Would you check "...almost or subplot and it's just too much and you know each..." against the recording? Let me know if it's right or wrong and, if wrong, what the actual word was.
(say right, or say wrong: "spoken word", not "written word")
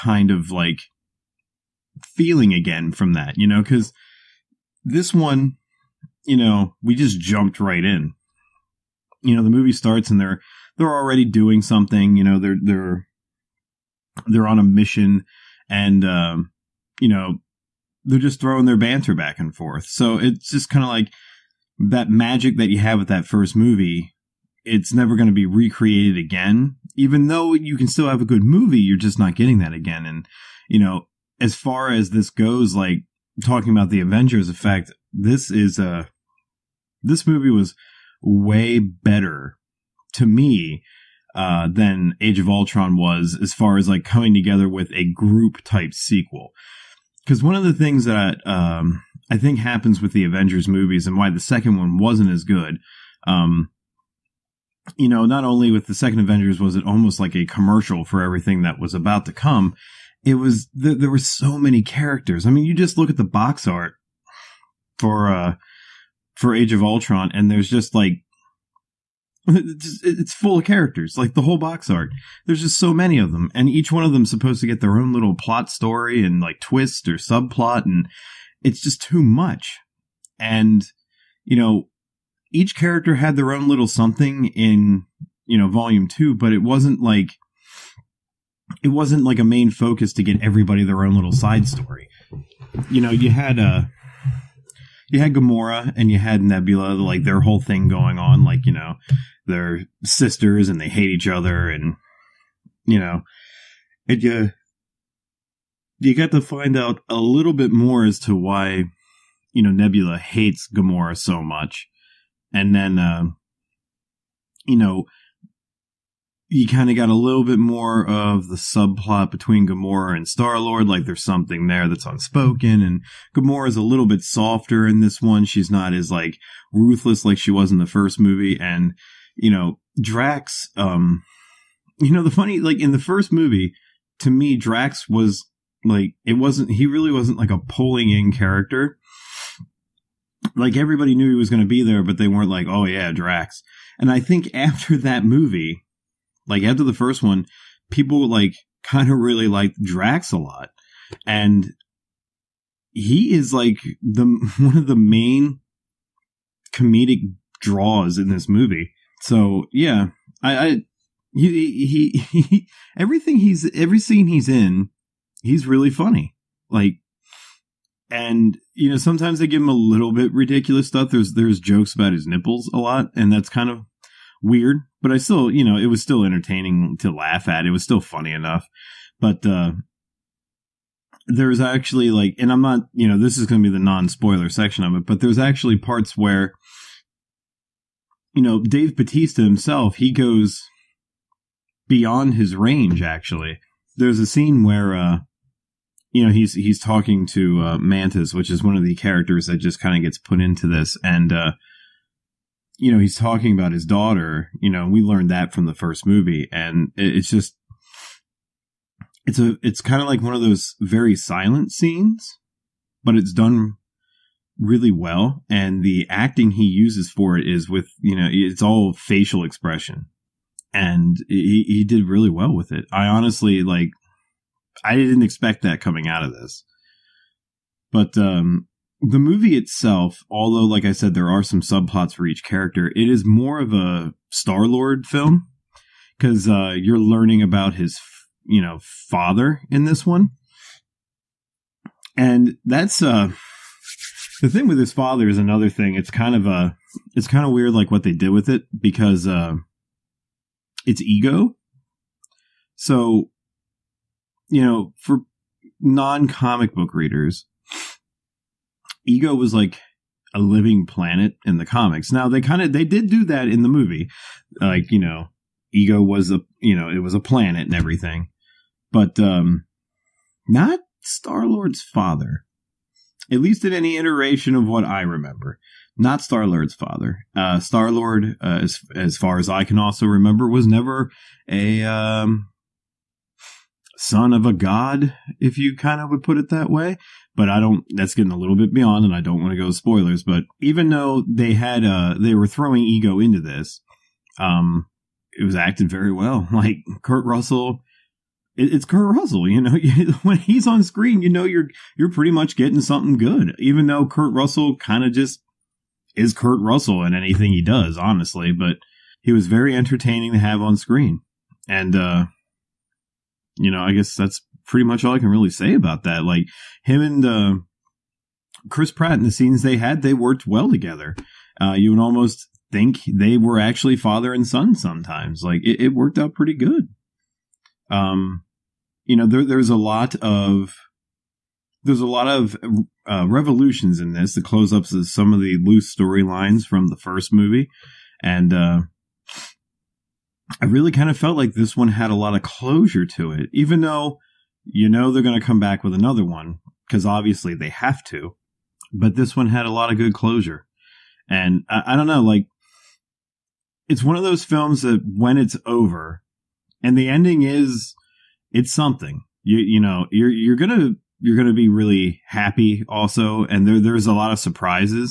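wrong: "twist", not "almost".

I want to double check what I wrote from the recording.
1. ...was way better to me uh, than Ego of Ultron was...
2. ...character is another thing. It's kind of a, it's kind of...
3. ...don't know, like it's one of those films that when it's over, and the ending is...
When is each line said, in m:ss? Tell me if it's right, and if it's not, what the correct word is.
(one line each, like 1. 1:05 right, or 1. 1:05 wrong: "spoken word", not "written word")
1. 0:37 wrong: "Age", not "Ego"
2. 4:04 wrong: "father", not "character"
3. 5:51 right.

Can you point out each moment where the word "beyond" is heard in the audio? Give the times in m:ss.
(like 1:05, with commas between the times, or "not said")
3:11, 4:48.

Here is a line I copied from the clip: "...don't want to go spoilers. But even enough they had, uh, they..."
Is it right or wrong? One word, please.
wrong.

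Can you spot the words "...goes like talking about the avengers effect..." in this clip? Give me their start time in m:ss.
0:32.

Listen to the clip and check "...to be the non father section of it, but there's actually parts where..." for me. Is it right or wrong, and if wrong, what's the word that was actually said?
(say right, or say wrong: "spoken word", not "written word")
wrong: "spoiler", not "father".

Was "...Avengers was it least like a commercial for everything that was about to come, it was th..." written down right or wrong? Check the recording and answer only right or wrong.
wrong.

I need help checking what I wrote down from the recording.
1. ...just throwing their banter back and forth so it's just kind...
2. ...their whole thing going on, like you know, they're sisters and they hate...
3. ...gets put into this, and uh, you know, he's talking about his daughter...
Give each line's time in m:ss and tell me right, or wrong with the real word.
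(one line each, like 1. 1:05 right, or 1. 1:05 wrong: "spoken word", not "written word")
1. 0:18 right
2. 1:37 right
3. 3:20 right.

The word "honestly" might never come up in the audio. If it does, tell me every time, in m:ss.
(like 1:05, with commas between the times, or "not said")
3:43, 5:07.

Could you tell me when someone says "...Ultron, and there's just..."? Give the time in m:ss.
1:06.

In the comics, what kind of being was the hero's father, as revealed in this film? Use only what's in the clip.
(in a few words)
A living planet.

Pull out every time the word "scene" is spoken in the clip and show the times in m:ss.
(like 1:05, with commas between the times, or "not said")
2:43, 3:14, 3:31, 5:19.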